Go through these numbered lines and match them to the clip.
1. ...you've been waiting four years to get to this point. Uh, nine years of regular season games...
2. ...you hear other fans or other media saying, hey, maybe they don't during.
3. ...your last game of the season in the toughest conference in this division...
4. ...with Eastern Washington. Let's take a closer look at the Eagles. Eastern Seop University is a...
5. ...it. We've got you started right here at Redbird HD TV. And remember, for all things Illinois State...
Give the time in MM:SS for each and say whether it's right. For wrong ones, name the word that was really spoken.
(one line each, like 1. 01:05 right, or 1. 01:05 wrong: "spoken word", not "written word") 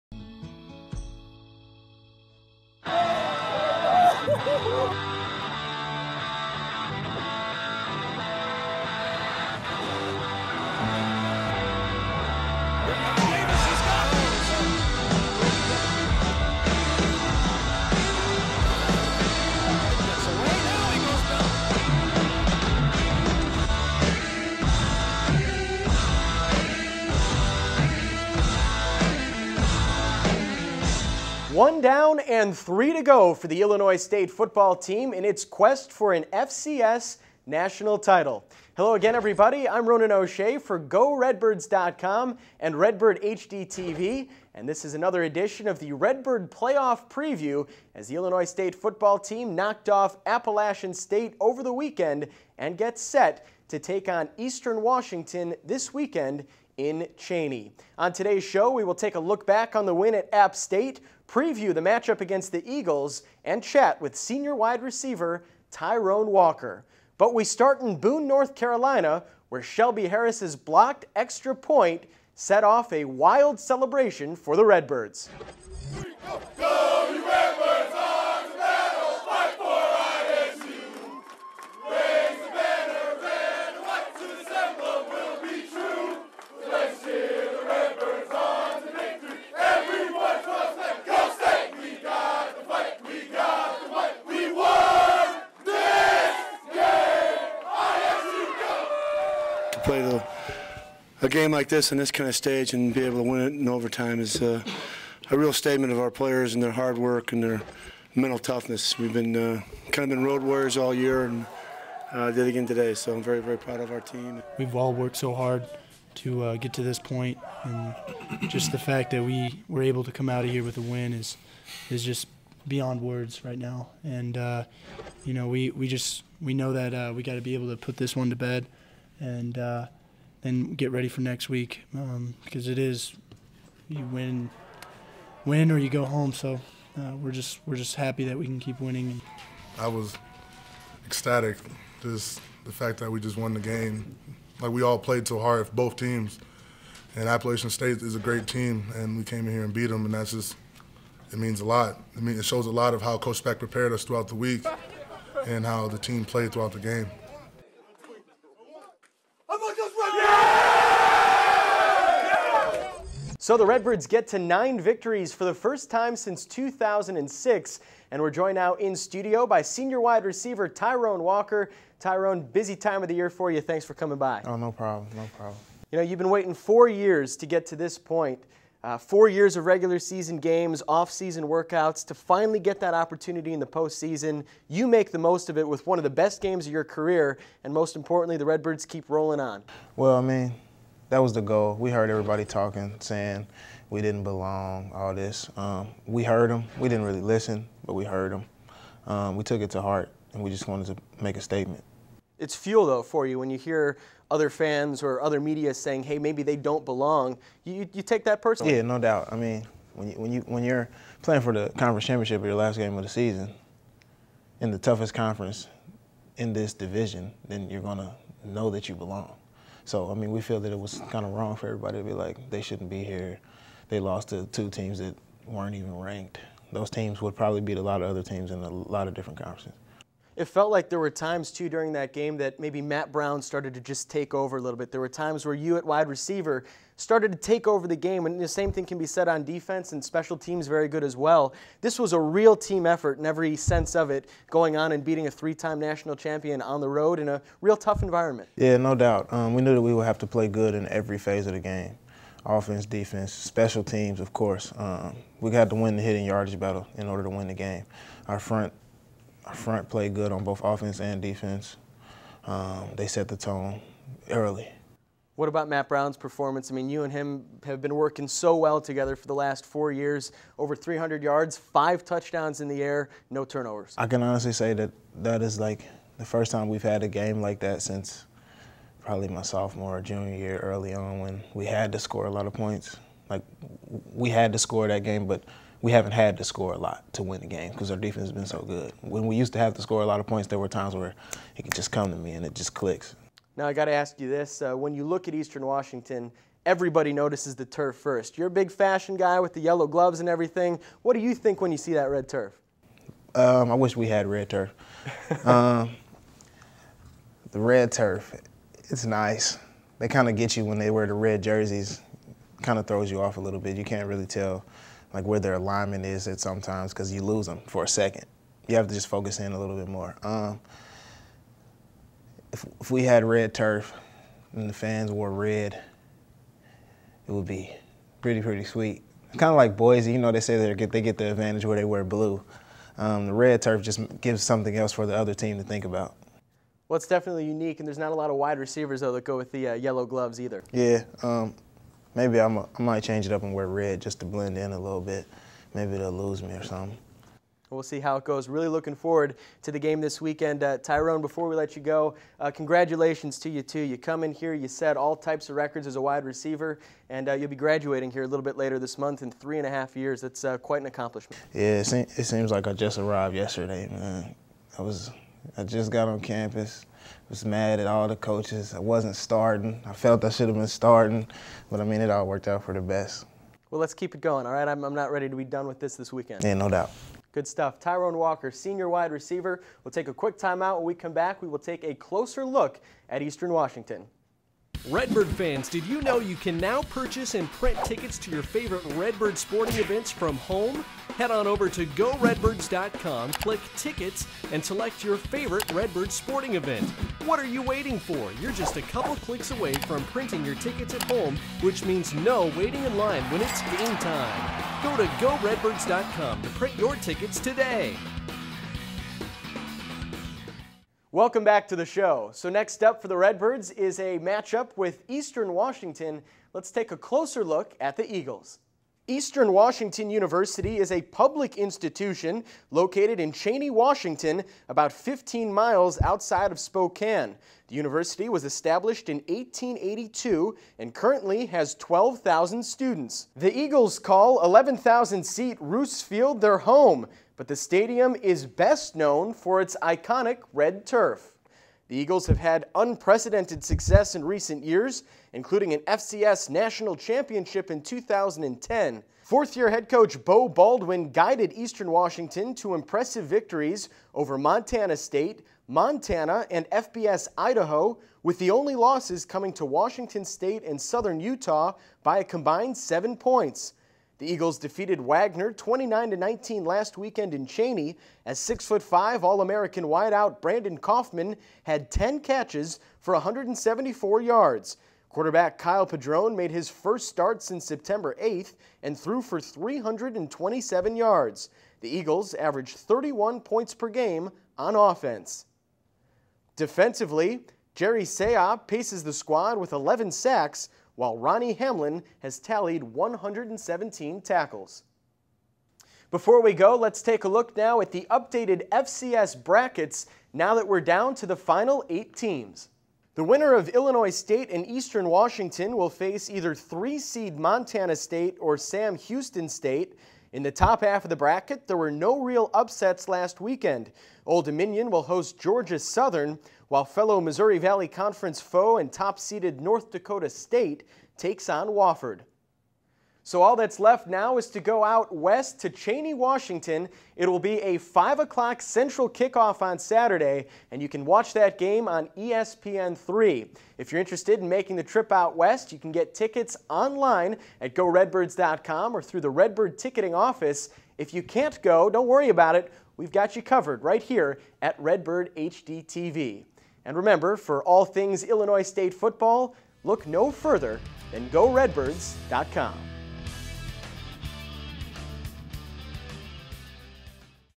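1. 02:56 wrong: "four", not "nine"
2. 03:23 wrong: "belong", not "during"
3. 03:32 right
4. 06:54 wrong: "Washington", not "Seop"
5. 09:02 wrong: "covered", not "started".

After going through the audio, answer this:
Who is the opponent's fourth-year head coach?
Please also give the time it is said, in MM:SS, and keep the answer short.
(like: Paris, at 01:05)
Beau Baldwin, at 07:30.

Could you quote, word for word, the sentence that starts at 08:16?
Before we go, let's take a look now at the updated FCS brackets now that we're down to the final eight teams.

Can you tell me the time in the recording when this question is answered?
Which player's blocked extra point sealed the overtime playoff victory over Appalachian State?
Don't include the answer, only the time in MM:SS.
01:09.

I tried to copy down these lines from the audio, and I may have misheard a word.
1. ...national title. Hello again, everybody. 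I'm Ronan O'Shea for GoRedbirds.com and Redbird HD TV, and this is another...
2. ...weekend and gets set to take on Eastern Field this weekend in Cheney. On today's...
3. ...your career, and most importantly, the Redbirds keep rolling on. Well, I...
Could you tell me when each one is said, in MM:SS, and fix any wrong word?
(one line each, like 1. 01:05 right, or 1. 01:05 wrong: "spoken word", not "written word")
1. 00:37 right
2. 00:51 wrong: "Washington", not "Field"
3. 03:06 right.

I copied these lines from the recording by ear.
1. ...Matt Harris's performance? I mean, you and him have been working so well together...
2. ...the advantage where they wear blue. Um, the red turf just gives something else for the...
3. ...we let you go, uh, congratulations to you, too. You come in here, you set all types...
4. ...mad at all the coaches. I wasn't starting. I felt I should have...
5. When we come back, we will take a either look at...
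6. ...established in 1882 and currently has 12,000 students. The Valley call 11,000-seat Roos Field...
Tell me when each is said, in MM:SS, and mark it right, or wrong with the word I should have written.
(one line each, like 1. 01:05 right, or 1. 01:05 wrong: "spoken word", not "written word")
1. 04:25 wrong: "Brown", not "Harris"
2. 05:31 right
3. 05:51 right
4. 06:07 right
5. 06:20 wrong: "closer", not "either"
6. 07:08 wrong: "Eagles", not "Valley".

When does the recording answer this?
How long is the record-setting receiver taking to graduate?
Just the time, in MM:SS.
05:59.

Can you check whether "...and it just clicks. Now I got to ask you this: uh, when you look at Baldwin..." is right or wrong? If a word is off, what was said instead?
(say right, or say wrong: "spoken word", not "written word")
wrong: "Eastern", not "Baldwin".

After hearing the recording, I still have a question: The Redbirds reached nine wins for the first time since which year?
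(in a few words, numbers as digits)
2006.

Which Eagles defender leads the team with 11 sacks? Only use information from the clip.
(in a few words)
Jerry Seop.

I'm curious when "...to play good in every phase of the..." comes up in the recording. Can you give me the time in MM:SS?
04:10.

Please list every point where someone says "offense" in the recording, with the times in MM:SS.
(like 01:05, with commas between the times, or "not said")
04:12, 04:20, 08:04.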